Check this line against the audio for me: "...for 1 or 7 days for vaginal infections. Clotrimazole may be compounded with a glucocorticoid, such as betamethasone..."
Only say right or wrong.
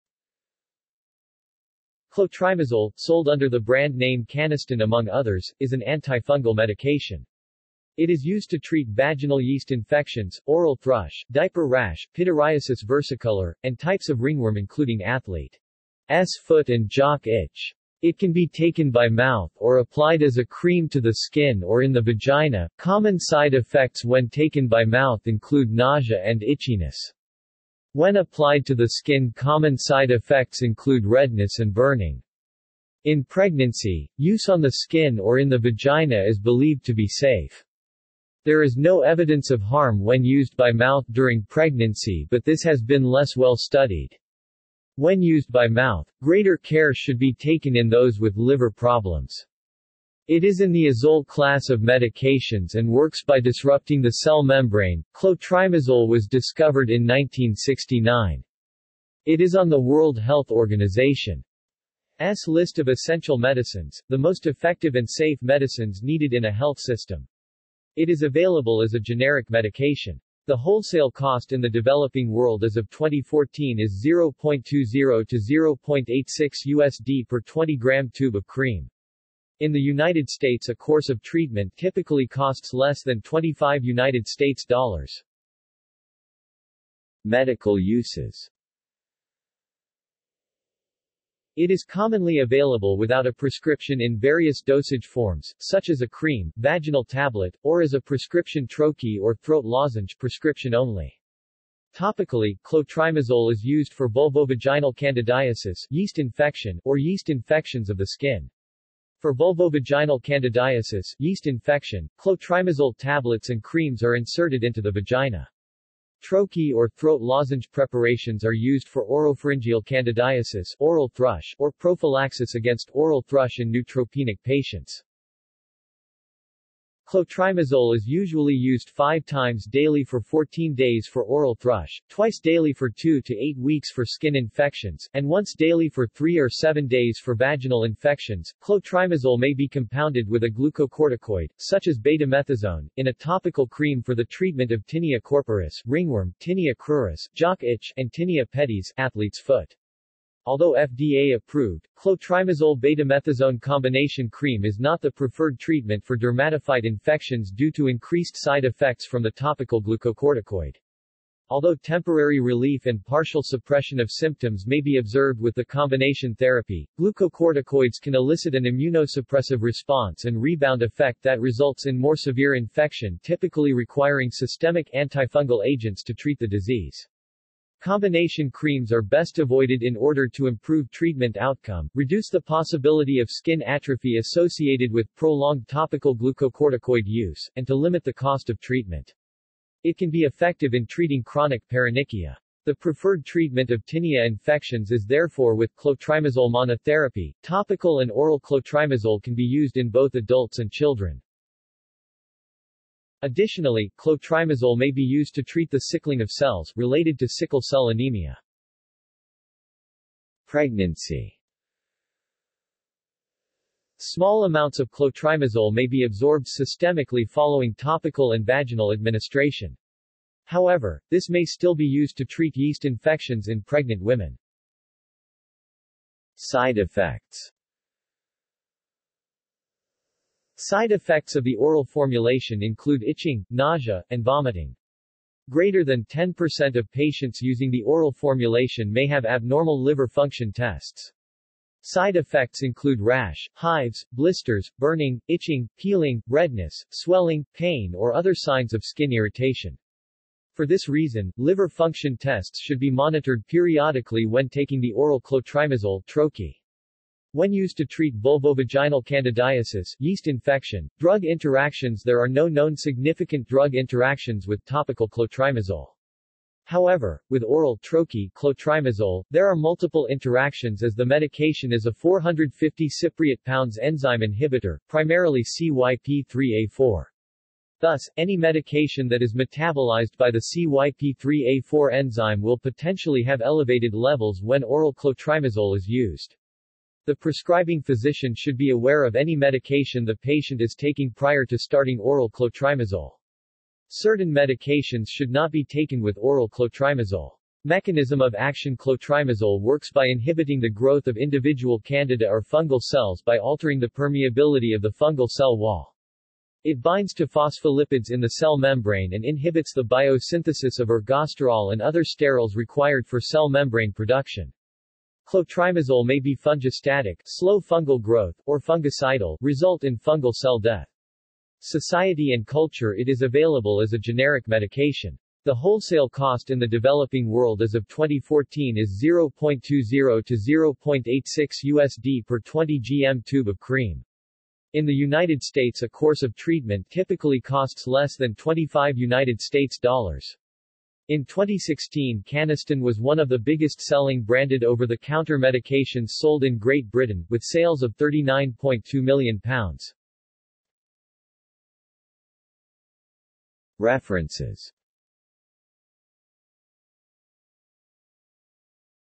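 wrong.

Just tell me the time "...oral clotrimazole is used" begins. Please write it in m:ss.
4:44.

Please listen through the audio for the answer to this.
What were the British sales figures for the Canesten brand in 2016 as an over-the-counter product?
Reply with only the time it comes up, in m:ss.
5:47.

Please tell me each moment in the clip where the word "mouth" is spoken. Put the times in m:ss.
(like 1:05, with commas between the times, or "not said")
0:19, 0:24, 0:40, 0:45.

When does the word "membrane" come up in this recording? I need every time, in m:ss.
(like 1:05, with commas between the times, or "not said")
0:54, 5:08, 5:13.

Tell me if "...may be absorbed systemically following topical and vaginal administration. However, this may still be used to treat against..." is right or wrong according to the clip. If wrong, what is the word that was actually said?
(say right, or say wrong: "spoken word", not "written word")
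wrong: "yeast", not "against".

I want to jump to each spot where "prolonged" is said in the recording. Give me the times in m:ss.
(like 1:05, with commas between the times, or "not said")
3:05.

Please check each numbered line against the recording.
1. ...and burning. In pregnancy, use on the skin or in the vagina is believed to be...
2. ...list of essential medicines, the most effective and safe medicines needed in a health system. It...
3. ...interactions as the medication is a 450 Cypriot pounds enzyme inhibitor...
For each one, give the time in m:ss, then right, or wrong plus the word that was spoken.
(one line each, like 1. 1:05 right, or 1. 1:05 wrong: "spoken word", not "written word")
1. 0:31 right
2. 1:02 right
3. 4:30 right.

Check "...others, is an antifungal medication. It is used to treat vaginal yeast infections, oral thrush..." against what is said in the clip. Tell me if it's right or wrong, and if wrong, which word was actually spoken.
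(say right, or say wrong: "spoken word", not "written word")
right.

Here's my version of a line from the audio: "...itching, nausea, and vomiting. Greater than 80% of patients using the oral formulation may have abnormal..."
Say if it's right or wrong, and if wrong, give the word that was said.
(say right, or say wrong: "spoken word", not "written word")
wrong: "10", not "80".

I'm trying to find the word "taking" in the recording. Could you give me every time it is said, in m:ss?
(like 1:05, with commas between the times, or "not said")
4:14, 4:50.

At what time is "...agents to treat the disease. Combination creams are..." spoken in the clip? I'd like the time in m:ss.
2:55.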